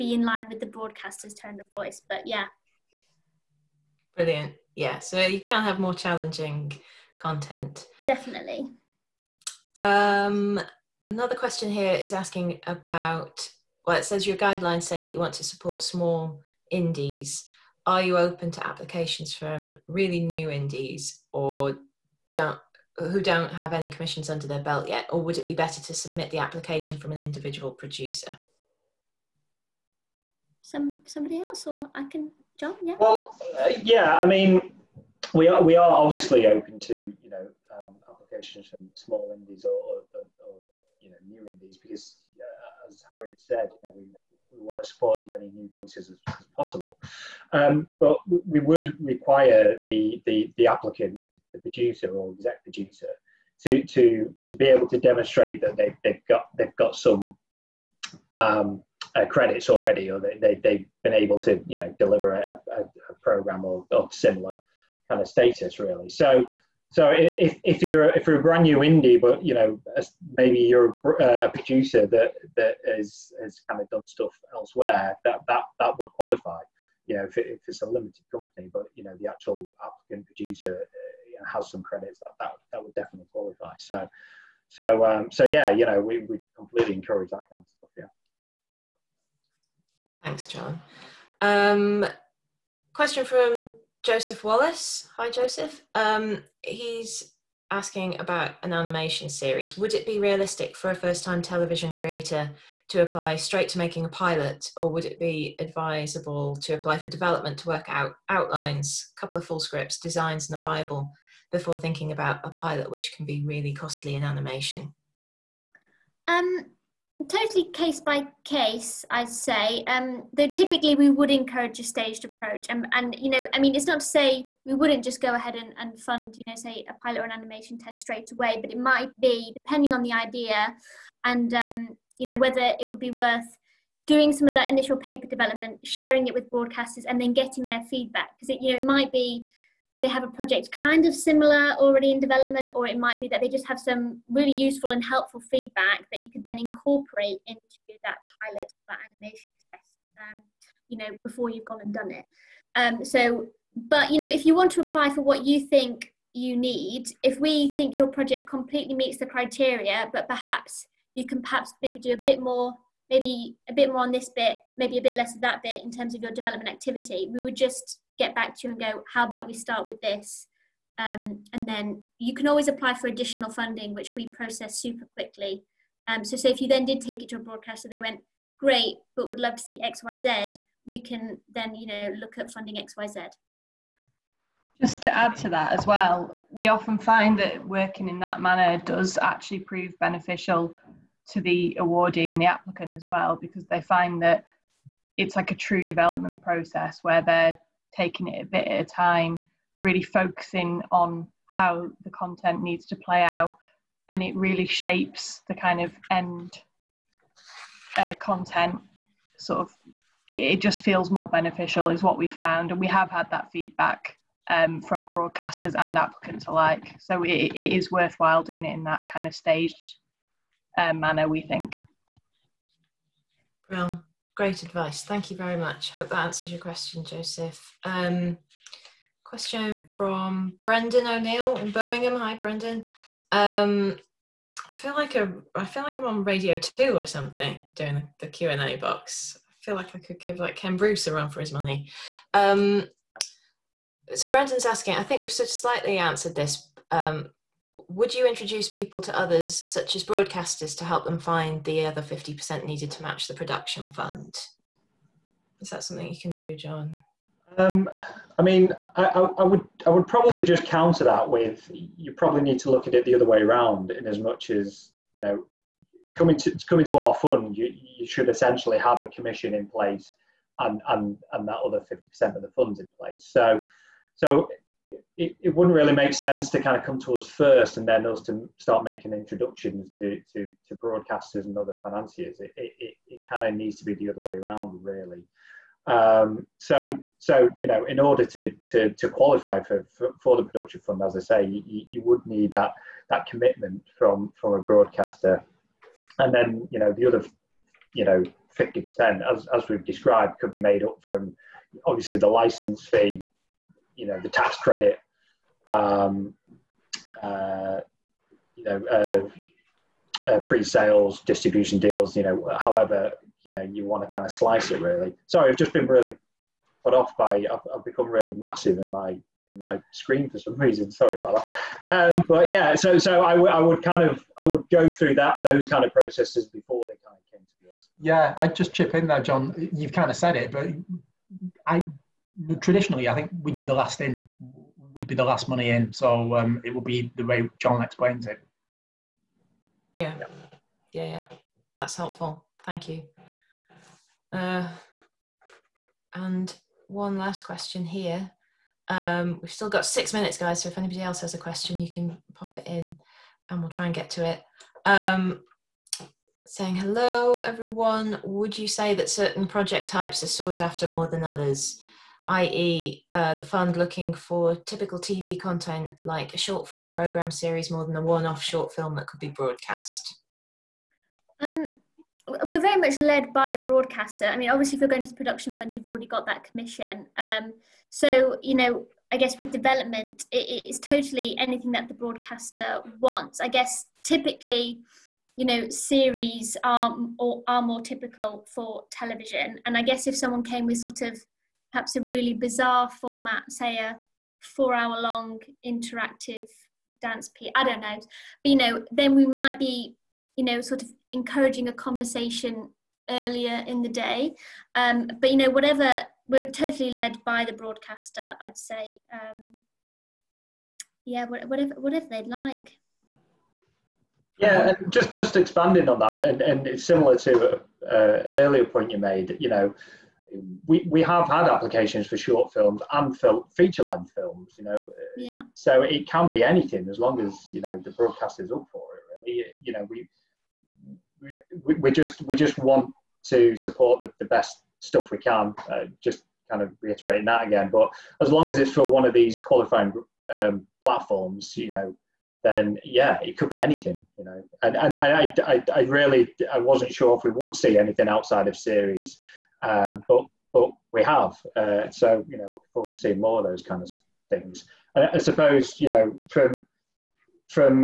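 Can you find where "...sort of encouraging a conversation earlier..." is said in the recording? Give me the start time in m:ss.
6:40.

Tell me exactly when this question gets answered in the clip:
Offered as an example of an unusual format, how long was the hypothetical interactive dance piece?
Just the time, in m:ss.
6:34.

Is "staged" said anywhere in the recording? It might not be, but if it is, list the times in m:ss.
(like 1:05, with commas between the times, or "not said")
2:01, 3:39.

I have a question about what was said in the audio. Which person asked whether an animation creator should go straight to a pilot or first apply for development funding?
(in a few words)
Joseph Wallace.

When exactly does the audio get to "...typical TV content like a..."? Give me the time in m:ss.
6:04.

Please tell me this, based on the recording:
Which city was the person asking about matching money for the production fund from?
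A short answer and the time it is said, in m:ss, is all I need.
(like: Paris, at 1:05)
Birmingham, at 3:51.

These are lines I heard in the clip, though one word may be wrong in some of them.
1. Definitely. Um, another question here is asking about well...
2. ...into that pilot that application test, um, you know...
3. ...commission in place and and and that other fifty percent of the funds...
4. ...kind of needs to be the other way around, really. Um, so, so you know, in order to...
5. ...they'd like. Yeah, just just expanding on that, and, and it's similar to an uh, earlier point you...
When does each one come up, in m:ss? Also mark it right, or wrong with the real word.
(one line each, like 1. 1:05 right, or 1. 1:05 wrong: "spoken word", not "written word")
1. 0:08 right
2. 2:27 wrong: "animation", not "application"
3. 4:29 right
4. 4:43 right
5. 6:52 right.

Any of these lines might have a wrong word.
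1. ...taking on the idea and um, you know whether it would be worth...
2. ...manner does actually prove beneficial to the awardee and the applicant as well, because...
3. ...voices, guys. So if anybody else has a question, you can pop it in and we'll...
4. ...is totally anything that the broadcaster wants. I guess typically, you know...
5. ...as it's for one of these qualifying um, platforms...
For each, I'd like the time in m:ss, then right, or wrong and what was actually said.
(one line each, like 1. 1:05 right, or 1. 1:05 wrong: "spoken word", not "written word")
1. 2:09 wrong: "depending", not "taking"
2. 3:08 right
3. 5:50 wrong: "minutes", not "voices"
4. 6:20 right
5. 7:18 right.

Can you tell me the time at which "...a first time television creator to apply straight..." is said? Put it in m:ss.
1:40.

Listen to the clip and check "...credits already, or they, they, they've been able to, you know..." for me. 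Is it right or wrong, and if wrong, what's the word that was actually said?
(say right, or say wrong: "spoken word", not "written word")
right.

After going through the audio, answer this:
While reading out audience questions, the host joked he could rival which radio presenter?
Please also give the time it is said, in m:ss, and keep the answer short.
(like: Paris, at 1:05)
Ken Bruce, at 4:00.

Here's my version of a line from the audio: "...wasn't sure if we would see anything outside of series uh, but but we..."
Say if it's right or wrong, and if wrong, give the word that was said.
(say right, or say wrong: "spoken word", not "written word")
right.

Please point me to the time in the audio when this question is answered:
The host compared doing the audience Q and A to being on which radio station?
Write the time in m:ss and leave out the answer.
3:56.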